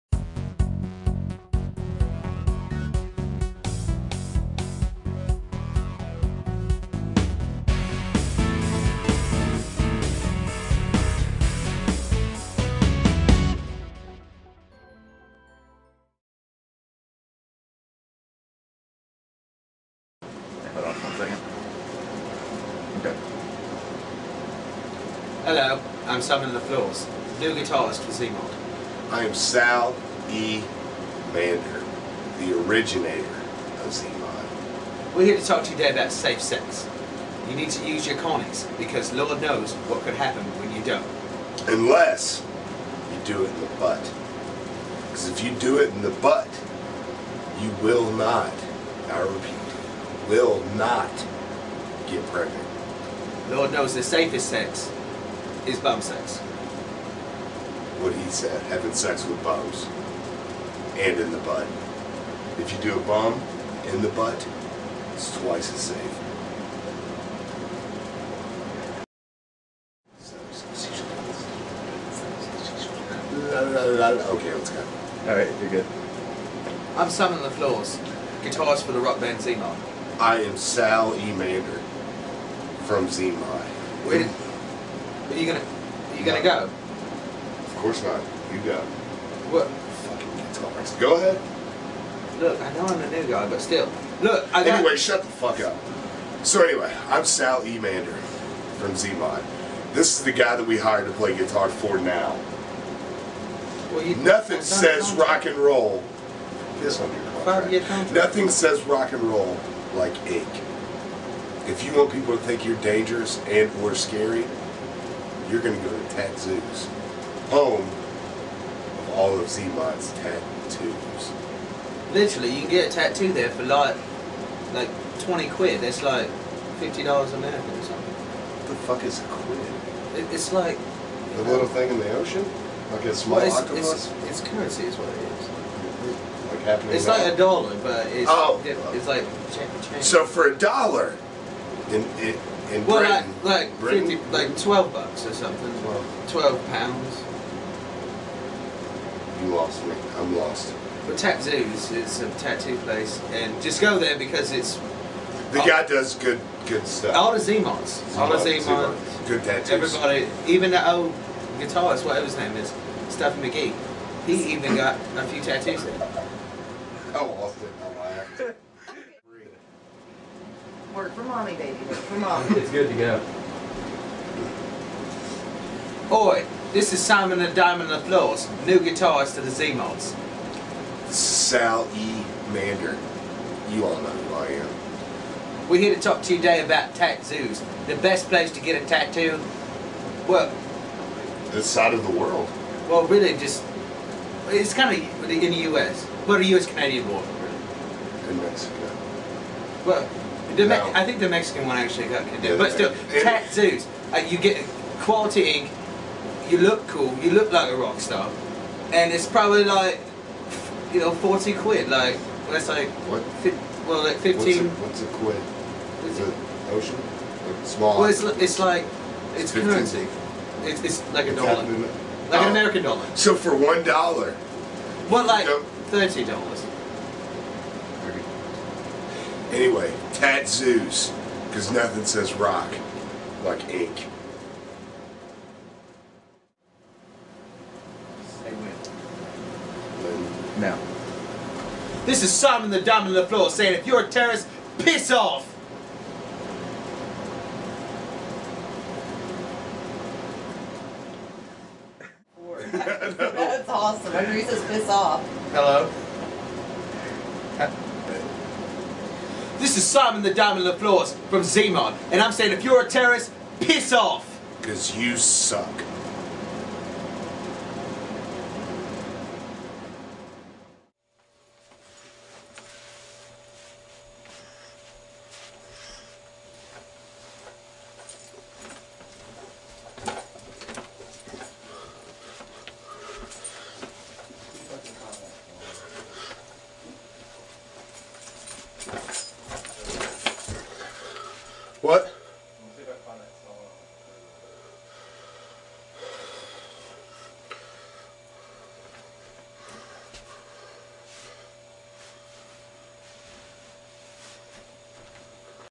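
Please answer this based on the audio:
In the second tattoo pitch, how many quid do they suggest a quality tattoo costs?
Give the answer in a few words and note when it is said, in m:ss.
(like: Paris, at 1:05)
40 quid, at 3:31.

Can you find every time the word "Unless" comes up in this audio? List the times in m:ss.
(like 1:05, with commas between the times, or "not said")
0:41.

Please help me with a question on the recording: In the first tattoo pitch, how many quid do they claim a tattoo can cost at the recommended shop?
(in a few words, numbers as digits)
20 quid.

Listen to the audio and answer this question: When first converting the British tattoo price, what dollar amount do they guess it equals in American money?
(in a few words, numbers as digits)
$50.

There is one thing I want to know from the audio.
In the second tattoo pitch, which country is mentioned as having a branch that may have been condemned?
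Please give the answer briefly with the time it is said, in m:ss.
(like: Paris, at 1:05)
Mexico, at 3:18.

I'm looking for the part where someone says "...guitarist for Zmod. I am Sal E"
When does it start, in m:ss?
0:27.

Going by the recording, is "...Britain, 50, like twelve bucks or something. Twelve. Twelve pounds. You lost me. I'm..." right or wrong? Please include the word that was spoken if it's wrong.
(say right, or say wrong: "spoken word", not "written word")
right.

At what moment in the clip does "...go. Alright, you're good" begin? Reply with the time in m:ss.
1:14.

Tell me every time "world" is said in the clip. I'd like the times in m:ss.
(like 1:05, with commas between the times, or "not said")
3:12.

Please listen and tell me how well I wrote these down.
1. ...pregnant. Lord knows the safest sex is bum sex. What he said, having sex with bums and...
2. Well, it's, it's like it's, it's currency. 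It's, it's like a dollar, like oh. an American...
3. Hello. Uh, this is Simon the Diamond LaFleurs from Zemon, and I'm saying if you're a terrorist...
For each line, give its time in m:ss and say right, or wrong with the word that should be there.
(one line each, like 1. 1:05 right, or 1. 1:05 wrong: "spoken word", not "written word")
1. 0:52 right
2. 3:38 right
3. 4:15 right.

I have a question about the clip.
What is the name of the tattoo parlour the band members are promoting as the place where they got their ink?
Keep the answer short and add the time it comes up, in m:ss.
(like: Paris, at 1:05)
Zoos, at 1:56.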